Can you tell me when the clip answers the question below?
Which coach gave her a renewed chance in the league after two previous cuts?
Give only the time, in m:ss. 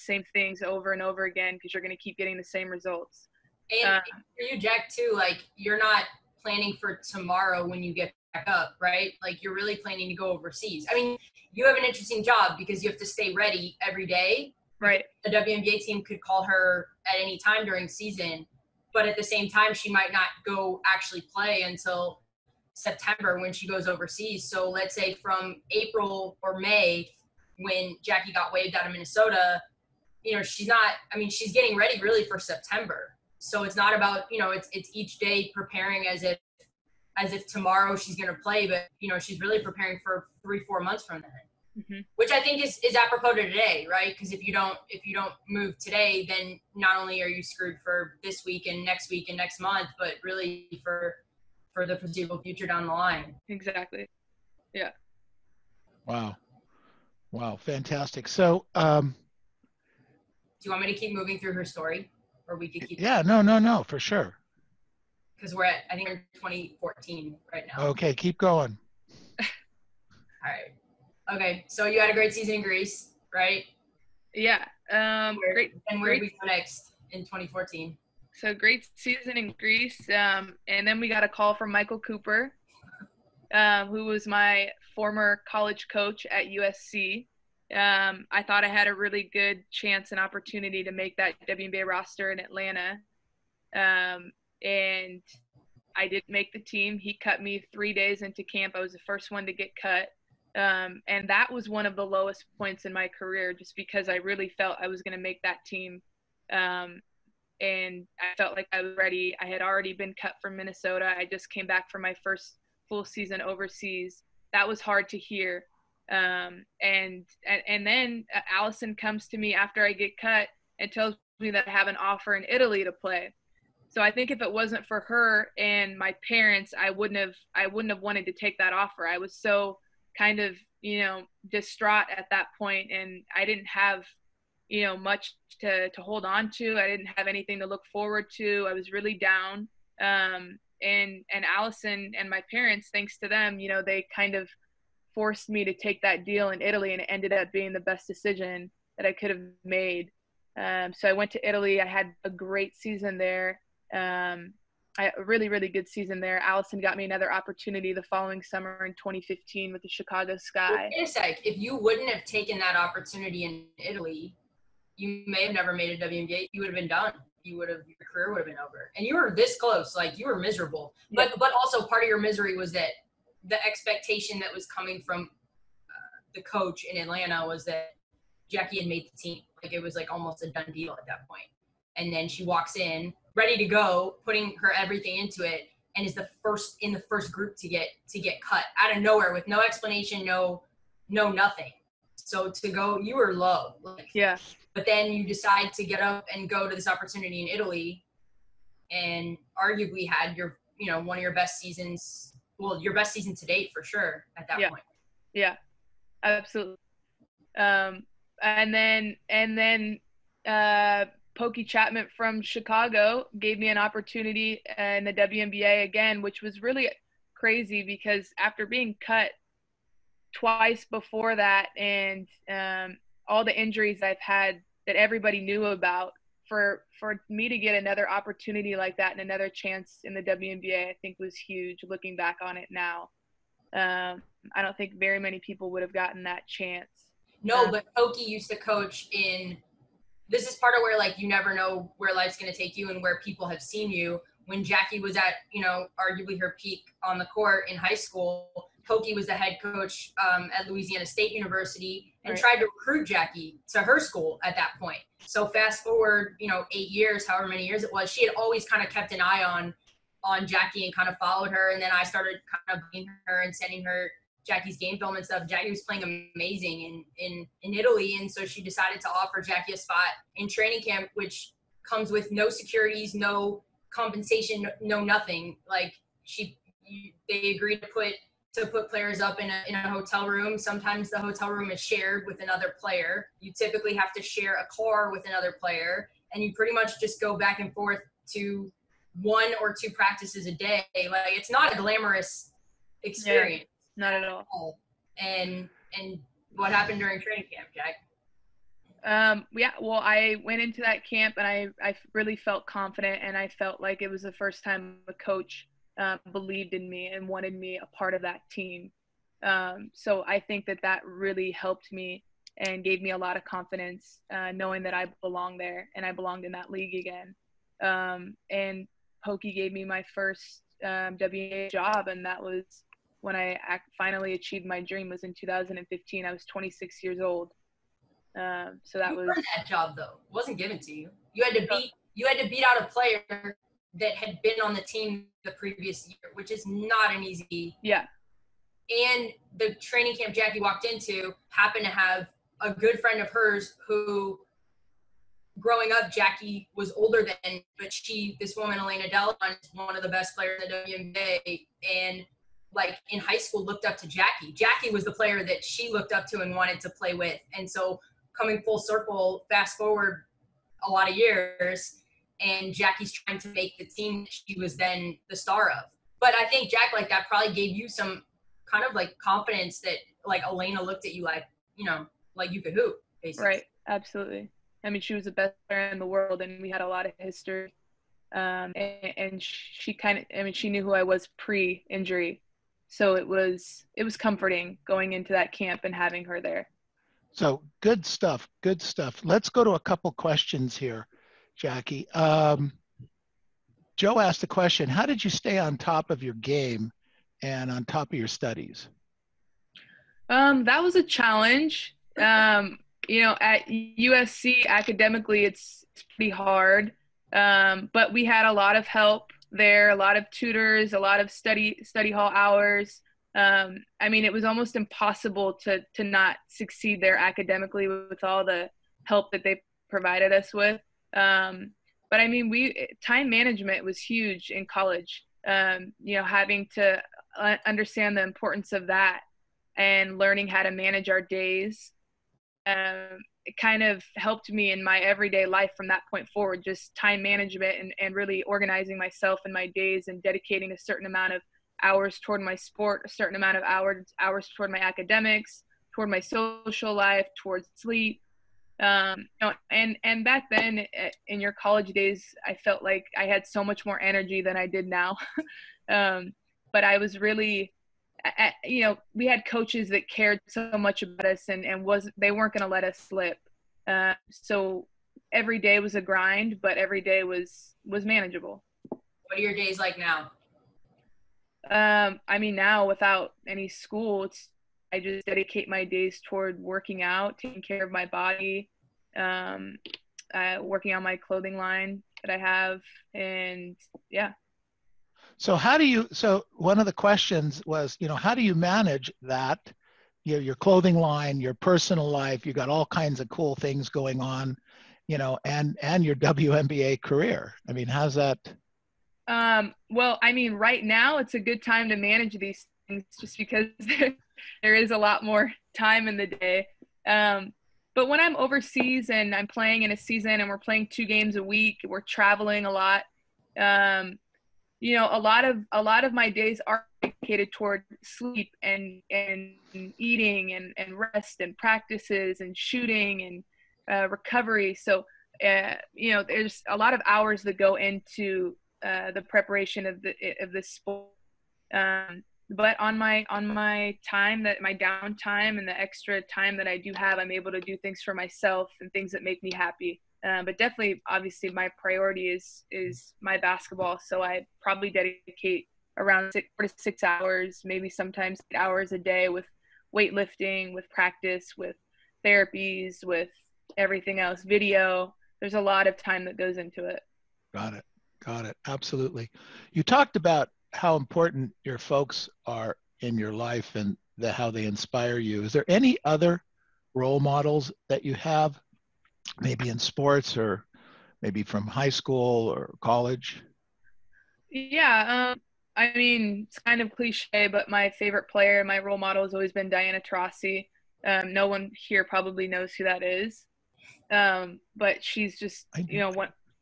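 3:31.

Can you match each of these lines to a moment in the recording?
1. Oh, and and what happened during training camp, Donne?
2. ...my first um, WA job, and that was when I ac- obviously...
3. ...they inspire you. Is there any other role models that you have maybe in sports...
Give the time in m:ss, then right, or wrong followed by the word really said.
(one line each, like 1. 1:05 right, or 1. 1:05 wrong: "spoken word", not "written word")
1. 4:54 wrong: "Jack", not "Donne"
2. 5:19 wrong: "finally", not "obviously"
3. 9:24 right.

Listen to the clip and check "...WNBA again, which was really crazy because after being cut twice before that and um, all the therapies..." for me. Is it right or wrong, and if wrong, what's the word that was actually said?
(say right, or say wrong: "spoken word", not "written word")
wrong: "injuries", not "therapies".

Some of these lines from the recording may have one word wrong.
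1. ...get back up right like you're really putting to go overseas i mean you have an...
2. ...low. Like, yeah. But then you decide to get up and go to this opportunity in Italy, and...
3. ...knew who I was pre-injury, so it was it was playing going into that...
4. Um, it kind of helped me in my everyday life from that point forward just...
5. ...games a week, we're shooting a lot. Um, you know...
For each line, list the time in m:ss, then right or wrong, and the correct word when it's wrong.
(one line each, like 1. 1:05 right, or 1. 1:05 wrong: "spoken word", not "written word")
1. 0:07 wrong: "planning", not "putting"
2. 3:13 right
3. 6:20 wrong: "comforting", not "playing"
4. 7:12 right
5. 8:31 wrong: "traveling", not "shooting".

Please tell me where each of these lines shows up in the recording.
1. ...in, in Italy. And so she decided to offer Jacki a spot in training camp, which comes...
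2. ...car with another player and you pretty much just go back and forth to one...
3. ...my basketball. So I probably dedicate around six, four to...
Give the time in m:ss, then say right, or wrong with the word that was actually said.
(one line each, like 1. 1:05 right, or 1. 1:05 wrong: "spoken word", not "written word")
1. 4:27 right
2. 4:44 right
3. 9:03 right.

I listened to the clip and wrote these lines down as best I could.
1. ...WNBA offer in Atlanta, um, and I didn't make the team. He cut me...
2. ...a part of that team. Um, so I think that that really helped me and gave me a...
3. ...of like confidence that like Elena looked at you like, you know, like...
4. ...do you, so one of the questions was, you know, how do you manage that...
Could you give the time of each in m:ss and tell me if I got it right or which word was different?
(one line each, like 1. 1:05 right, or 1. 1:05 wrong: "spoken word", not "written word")
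1. 1:31 wrong: "roster", not "offer"
2. 5:07 right
3. 6:08 right
4. 8:05 right.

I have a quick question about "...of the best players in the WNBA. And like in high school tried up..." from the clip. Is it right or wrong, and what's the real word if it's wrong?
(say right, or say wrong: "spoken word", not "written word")
wrong: "looked", not "tried".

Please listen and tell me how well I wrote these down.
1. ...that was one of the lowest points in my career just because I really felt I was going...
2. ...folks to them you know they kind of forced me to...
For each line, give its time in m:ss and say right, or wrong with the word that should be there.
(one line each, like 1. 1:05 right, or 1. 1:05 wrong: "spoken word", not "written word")
1. 1:41 right
2. 2:22 wrong: "thanks", not "folks".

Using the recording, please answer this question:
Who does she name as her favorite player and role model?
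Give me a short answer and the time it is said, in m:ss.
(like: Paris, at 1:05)
Diana Taurasi, at 9:39.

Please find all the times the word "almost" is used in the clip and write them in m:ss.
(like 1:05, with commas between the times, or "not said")
3:00, 6:54.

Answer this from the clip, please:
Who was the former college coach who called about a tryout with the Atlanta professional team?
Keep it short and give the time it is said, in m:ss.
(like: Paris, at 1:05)
Michael Cooper, at 1:21.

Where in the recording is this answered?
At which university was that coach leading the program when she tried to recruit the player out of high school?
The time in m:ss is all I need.
4:10.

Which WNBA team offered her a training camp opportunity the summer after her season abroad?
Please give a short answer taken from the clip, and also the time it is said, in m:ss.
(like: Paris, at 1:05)
Chicago Sky, at 2:39.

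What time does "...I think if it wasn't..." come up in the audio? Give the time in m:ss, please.
2:04.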